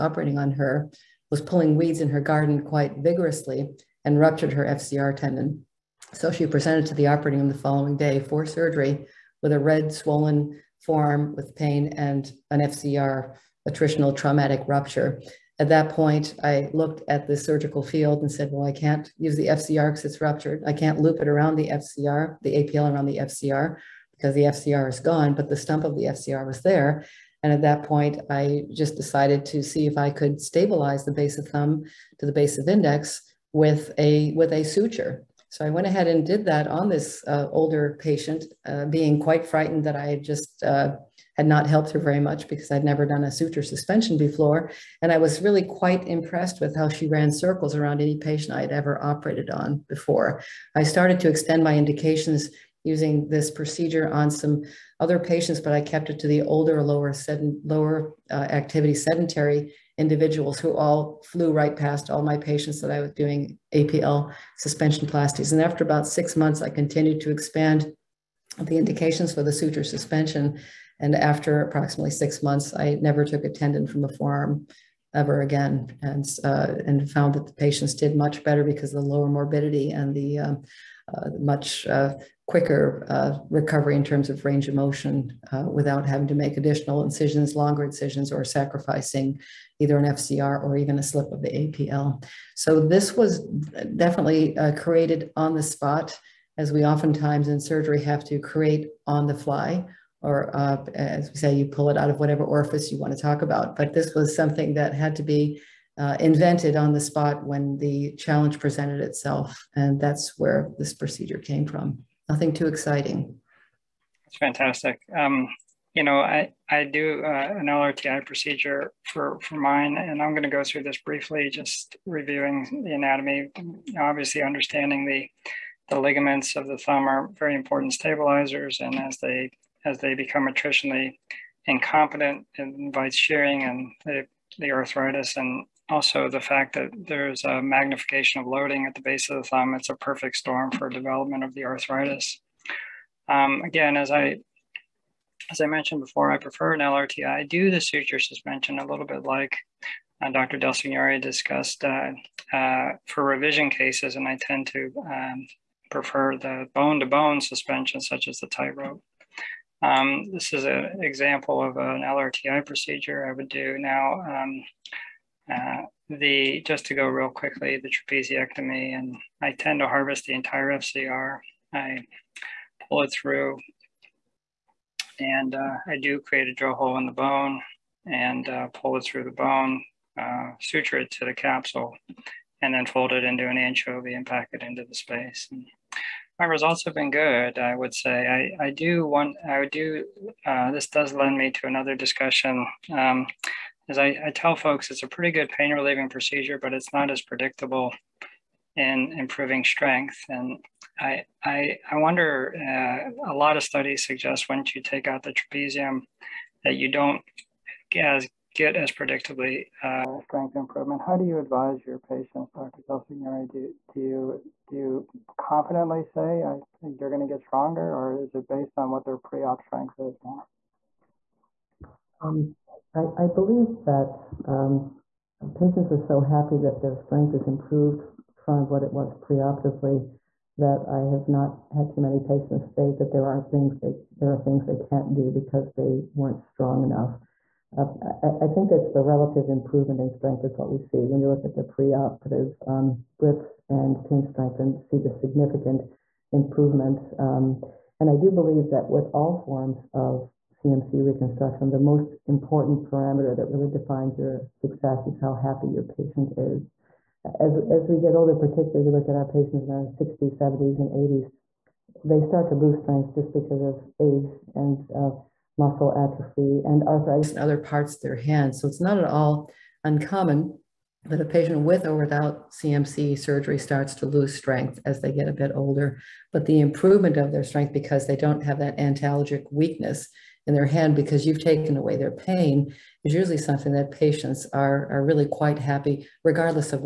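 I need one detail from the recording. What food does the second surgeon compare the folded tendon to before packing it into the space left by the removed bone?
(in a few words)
Anchovy.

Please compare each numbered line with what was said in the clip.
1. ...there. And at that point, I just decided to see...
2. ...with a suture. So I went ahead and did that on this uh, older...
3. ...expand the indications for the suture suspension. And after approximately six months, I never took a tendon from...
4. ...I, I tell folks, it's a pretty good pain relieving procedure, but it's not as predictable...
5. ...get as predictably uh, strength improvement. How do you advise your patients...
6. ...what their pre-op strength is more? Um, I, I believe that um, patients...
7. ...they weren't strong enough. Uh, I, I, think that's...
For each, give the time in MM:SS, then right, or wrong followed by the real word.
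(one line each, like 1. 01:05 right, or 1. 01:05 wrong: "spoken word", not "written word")
1. 00:26 right
2. 00:34 right
3. 01:07 right
4. 03:13 right
5. 03:28 right
6. 03:38 right
7. 03:55 right.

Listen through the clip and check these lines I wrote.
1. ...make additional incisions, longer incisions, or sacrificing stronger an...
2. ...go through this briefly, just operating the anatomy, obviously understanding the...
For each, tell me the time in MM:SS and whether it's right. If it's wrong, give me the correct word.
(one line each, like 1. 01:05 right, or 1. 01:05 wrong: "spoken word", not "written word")
1. 01:26 wrong: "either", not "stronger"
2. 02:00 wrong: "reviewing", not "operating".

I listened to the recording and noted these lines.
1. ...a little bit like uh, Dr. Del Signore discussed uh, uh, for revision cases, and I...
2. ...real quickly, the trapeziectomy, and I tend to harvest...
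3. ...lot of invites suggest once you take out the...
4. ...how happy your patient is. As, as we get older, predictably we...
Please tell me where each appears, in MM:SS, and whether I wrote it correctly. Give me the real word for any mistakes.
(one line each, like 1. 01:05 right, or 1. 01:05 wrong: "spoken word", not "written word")
1. 02:28 right
2. 02:47 right
3. 03:23 wrong: "studies", not "invites"
4. 04:15 wrong: "particularly", not "predictably".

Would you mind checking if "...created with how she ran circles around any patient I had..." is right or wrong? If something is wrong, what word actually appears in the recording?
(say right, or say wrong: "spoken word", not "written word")
wrong: "impressed", not "created".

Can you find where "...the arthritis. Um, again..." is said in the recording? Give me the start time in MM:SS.
02:21.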